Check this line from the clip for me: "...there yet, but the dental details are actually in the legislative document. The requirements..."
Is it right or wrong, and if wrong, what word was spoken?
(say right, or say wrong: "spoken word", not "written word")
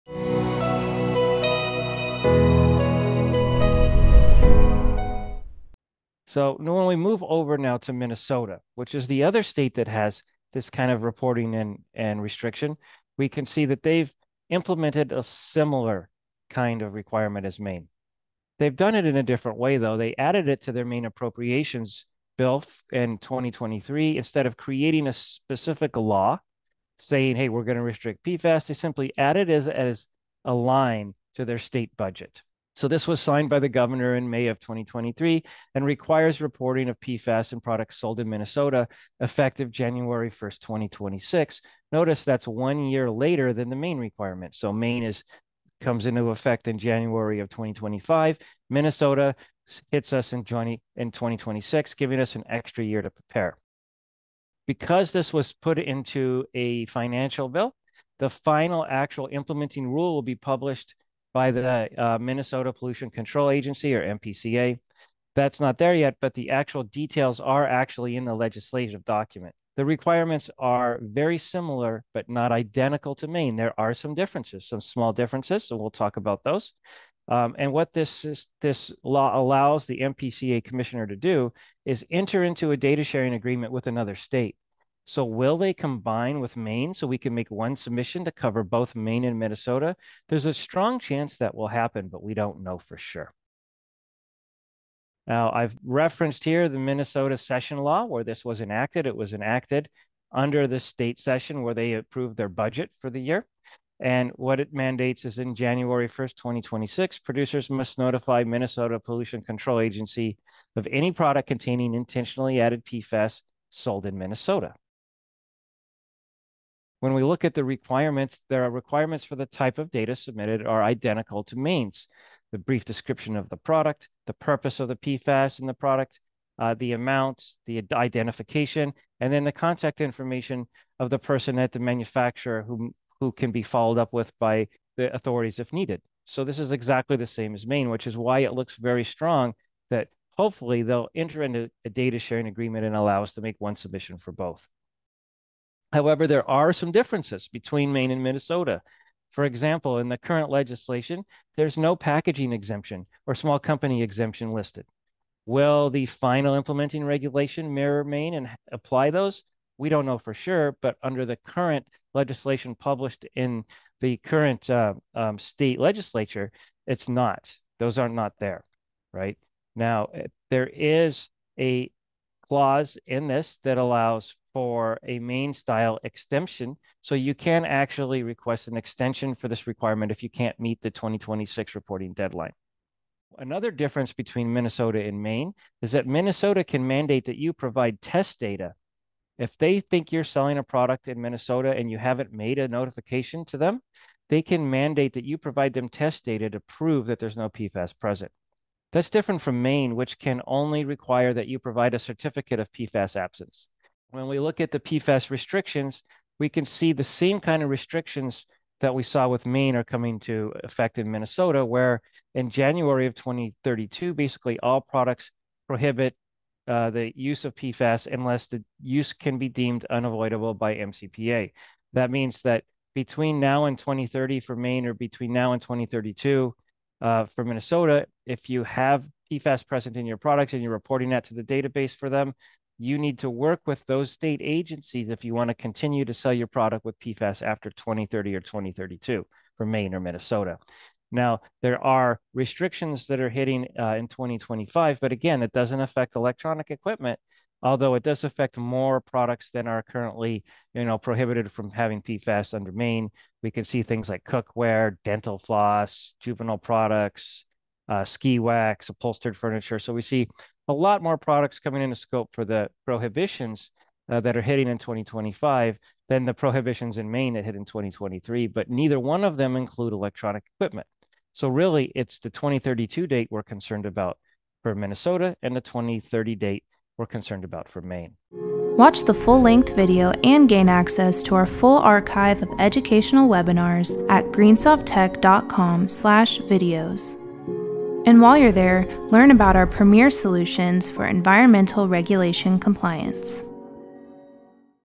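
wrong: "actual", not "dental".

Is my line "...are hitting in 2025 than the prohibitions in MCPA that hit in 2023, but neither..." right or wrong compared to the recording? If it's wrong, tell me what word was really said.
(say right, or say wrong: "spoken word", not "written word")
wrong: "Maine", not "MCPA".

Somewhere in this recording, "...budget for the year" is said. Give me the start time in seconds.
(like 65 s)
102 s.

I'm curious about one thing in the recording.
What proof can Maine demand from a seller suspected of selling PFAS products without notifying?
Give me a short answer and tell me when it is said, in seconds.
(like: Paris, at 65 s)
certificate of PFAS absence, at 201 s.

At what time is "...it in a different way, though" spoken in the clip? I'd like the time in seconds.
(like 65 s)
18 s.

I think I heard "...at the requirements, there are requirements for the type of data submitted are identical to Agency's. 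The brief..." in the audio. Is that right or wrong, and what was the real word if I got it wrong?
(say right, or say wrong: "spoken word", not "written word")
wrong: "Maine", not "Agency".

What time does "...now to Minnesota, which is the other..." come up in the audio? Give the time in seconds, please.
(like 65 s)
7 s.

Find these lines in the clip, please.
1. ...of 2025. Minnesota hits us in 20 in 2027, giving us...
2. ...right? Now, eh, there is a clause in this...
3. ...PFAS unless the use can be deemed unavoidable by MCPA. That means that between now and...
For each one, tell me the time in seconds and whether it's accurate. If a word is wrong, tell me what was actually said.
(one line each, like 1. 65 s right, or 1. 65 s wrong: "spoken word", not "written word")
1. 47 s wrong: "2026", not "2027"
2. 169 s right
3. 217 s right.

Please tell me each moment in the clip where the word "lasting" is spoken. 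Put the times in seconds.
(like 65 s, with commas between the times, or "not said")
not said.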